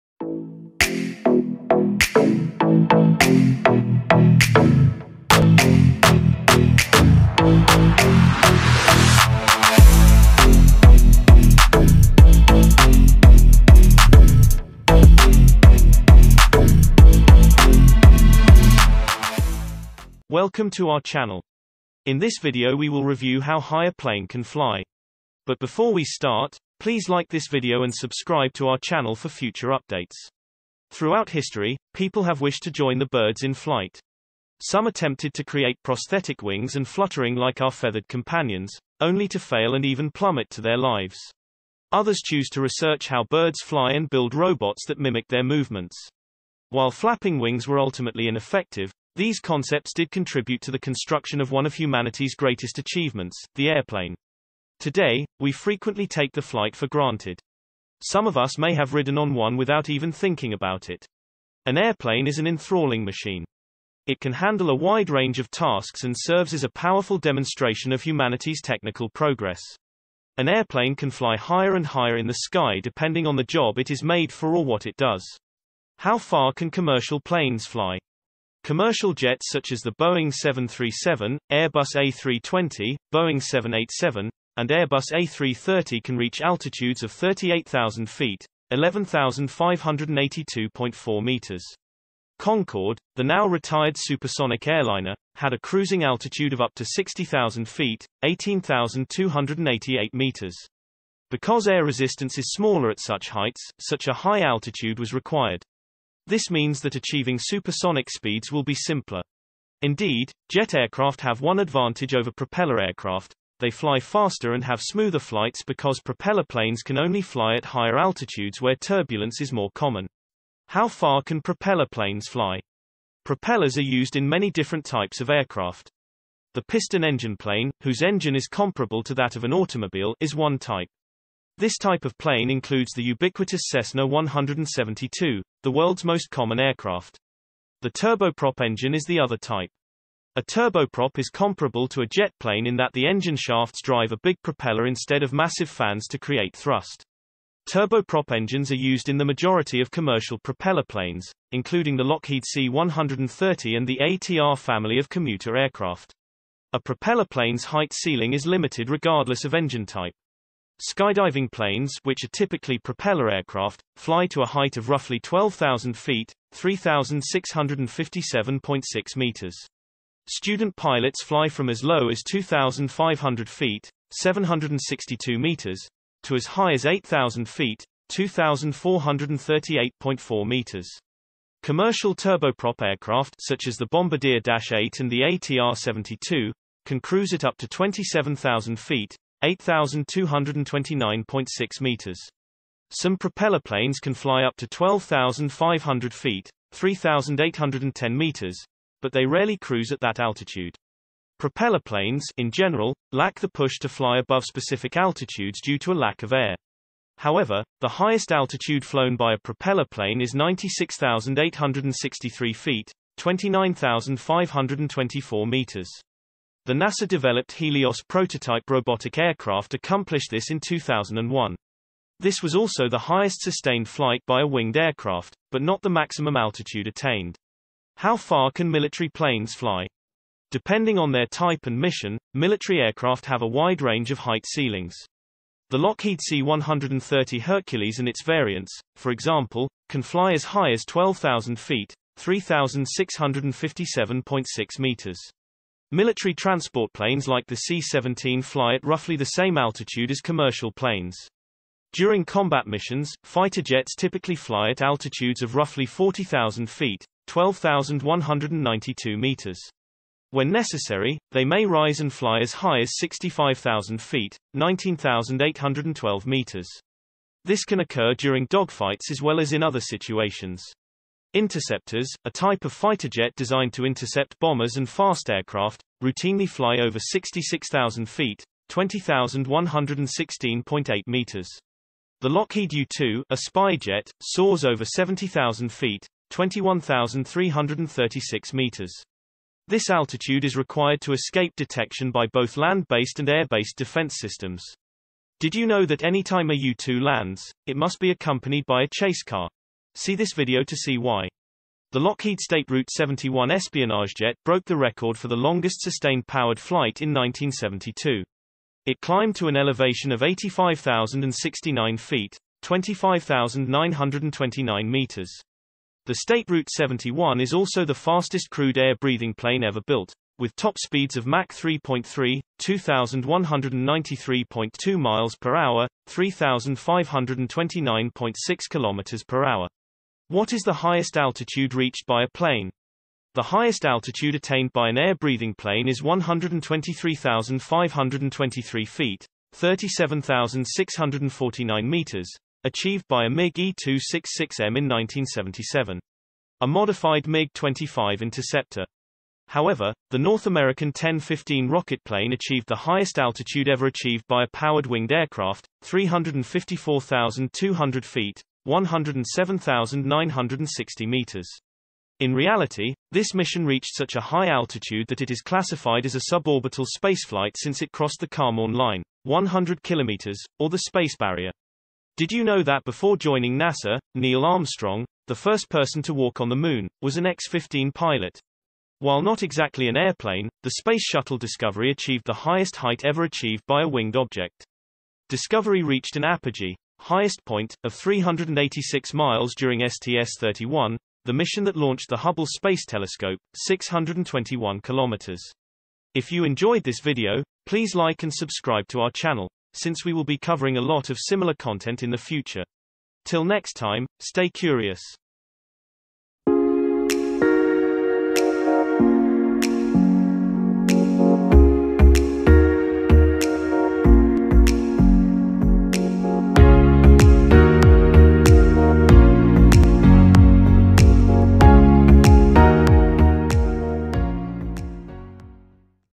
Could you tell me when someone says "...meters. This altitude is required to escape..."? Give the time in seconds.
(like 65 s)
288 s.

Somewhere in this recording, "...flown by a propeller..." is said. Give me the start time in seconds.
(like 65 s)
208 s.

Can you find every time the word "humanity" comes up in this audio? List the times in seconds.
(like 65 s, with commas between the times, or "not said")
51 s, 68 s.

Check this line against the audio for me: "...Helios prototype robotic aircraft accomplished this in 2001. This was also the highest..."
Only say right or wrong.
right.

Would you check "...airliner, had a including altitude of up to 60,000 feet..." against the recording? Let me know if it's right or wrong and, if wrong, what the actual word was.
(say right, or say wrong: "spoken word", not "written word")
wrong: "cruising", not "including".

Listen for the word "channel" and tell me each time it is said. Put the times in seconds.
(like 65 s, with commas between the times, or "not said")
21 s, 28 s, 399 s.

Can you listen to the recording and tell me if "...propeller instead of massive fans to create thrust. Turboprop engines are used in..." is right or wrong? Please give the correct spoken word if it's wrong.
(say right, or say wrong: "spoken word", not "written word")
right.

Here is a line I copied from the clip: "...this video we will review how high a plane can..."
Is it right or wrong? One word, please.
right.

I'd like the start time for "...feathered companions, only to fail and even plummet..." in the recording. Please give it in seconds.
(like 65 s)
37 s.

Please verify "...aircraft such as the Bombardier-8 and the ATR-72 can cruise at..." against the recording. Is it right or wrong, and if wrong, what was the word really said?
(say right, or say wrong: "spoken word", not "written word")
right.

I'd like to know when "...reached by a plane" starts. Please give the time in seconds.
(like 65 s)
331 s.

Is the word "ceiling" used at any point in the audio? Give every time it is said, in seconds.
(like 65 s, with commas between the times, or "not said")
157 s, 234 s.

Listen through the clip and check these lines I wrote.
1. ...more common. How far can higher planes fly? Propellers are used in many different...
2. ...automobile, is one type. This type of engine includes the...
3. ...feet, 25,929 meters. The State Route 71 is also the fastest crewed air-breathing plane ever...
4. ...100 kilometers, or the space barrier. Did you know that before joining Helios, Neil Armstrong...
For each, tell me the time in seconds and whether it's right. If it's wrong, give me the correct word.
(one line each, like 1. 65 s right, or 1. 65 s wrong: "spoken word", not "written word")
1. 119 s wrong: "propeller", not "higher"
2. 129 s wrong: "plane", not "engine"
3. 311 s right
4. 369 s wrong: "NASA", not "Helios".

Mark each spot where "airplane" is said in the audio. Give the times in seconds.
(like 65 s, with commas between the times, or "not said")
53 s, 61 s, 70 s, 379 s.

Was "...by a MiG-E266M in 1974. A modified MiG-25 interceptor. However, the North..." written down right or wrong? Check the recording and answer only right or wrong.
wrong.